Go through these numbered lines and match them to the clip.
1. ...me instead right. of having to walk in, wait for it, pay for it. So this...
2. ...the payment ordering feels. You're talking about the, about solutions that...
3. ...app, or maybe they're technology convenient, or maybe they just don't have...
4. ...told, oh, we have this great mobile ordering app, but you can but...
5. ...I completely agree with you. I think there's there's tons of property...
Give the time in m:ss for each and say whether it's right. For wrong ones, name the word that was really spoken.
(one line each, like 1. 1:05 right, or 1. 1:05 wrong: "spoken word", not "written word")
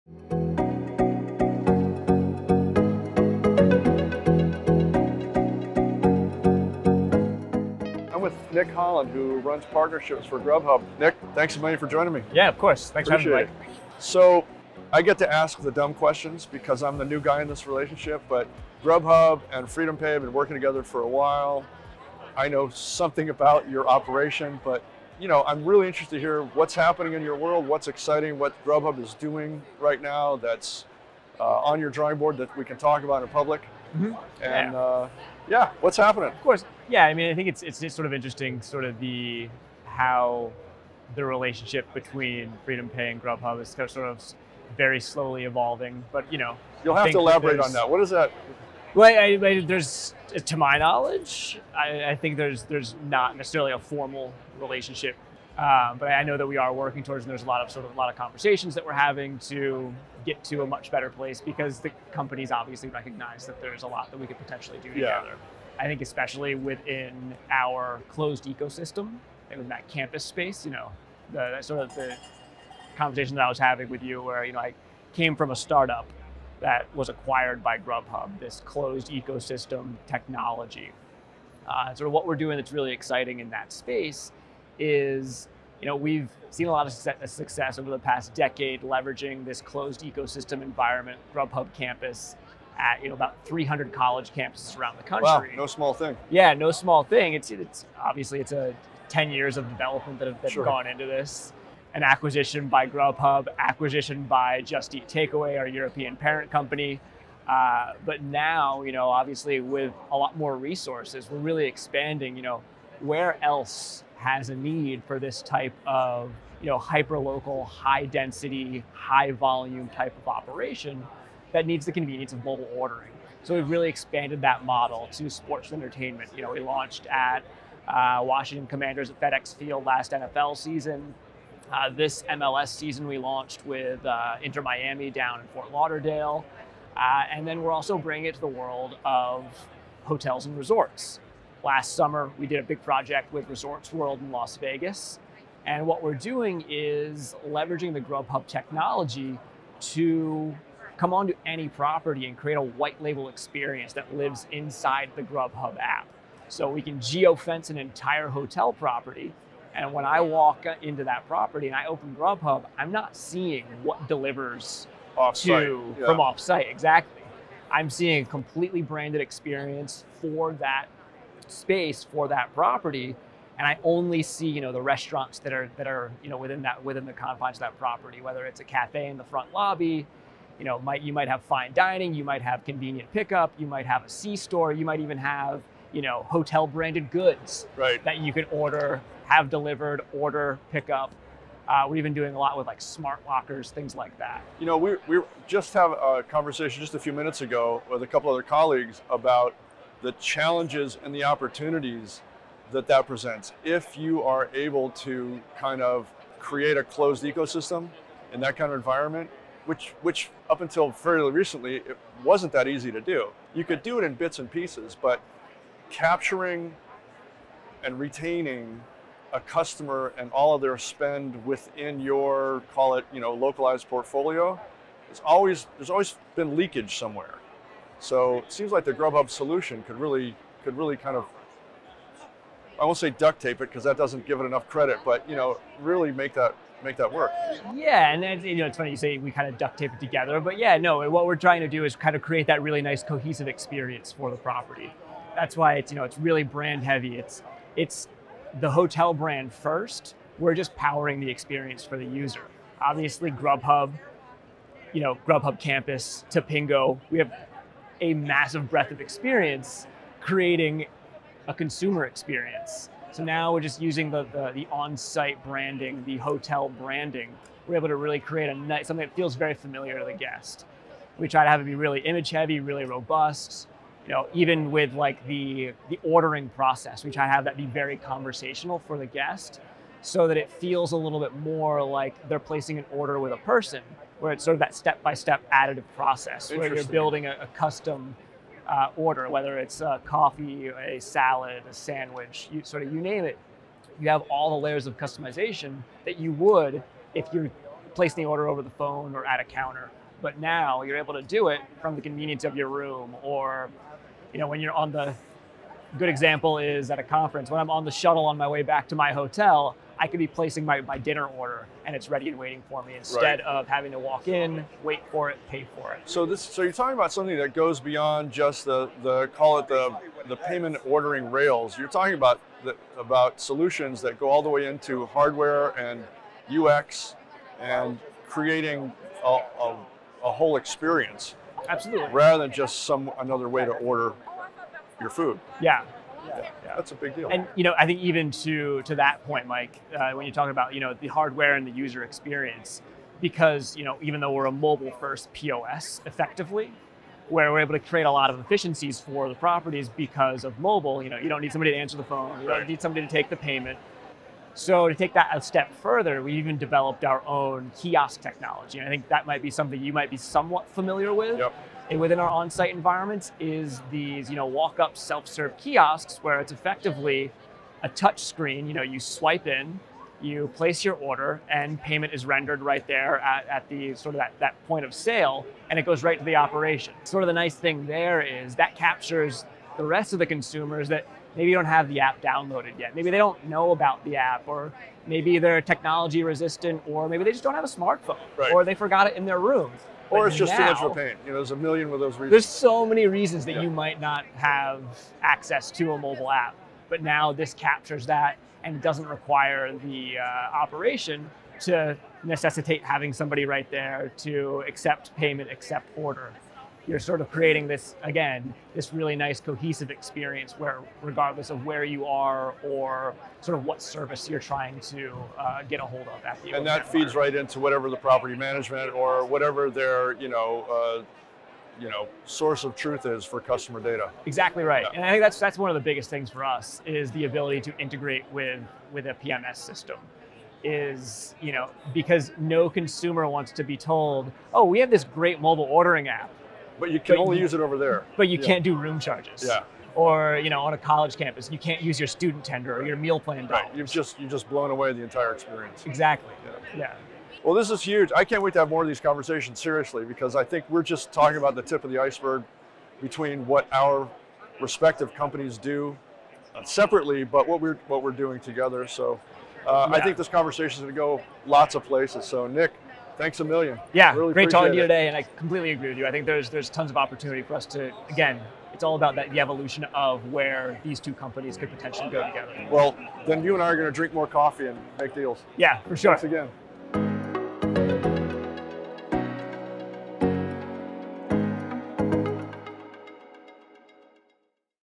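1. 5:12 right
2. 5:20 wrong: "rails", not "feels"
3. 6:24 wrong: "resistant", not "convenient"
4. 7:13 right
5. 7:45 wrong: "opportunity", not "property".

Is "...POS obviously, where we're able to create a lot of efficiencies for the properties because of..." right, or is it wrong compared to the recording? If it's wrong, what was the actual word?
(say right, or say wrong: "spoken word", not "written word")
wrong: "effectively", not "obviously".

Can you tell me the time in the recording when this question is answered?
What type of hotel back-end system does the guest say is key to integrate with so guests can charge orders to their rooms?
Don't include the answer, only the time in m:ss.
7:09.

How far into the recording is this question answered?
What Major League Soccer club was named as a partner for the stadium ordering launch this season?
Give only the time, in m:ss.
2:14.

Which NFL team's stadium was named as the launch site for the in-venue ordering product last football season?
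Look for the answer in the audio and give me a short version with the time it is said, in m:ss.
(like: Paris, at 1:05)
Washington Commanders, at 2:08.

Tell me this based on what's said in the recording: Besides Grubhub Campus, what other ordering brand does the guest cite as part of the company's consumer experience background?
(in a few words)
Tapingo.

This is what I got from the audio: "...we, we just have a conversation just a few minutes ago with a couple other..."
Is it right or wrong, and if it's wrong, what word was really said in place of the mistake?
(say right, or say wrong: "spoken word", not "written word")
right.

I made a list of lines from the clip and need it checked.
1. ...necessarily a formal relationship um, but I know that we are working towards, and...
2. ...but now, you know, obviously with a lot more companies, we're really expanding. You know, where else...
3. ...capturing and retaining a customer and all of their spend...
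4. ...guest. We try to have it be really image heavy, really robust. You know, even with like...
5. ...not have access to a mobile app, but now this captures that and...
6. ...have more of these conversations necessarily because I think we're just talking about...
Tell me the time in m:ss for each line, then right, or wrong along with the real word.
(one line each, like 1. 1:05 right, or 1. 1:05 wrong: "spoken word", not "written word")
1. 0:53 right
2. 1:48 wrong: "resources", not "companies"
3. 3:35 right
4. 4:30 right
5. 6:34 right
6. 7:28 wrong: "seriously", not "necessarily".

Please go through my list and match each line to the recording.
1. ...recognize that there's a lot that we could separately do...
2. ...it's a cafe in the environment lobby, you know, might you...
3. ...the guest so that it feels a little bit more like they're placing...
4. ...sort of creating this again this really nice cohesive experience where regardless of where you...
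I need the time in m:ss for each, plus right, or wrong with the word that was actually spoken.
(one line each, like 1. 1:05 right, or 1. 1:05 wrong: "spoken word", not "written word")
1. 1:02 wrong: "potentially", not "separately"
2. 2:58 wrong: "front", not "environment"
3. 4:38 right
4. 6:46 right.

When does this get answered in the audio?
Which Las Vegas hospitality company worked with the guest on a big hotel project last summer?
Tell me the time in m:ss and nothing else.
2:23.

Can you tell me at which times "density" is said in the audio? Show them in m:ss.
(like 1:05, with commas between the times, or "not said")
1:57.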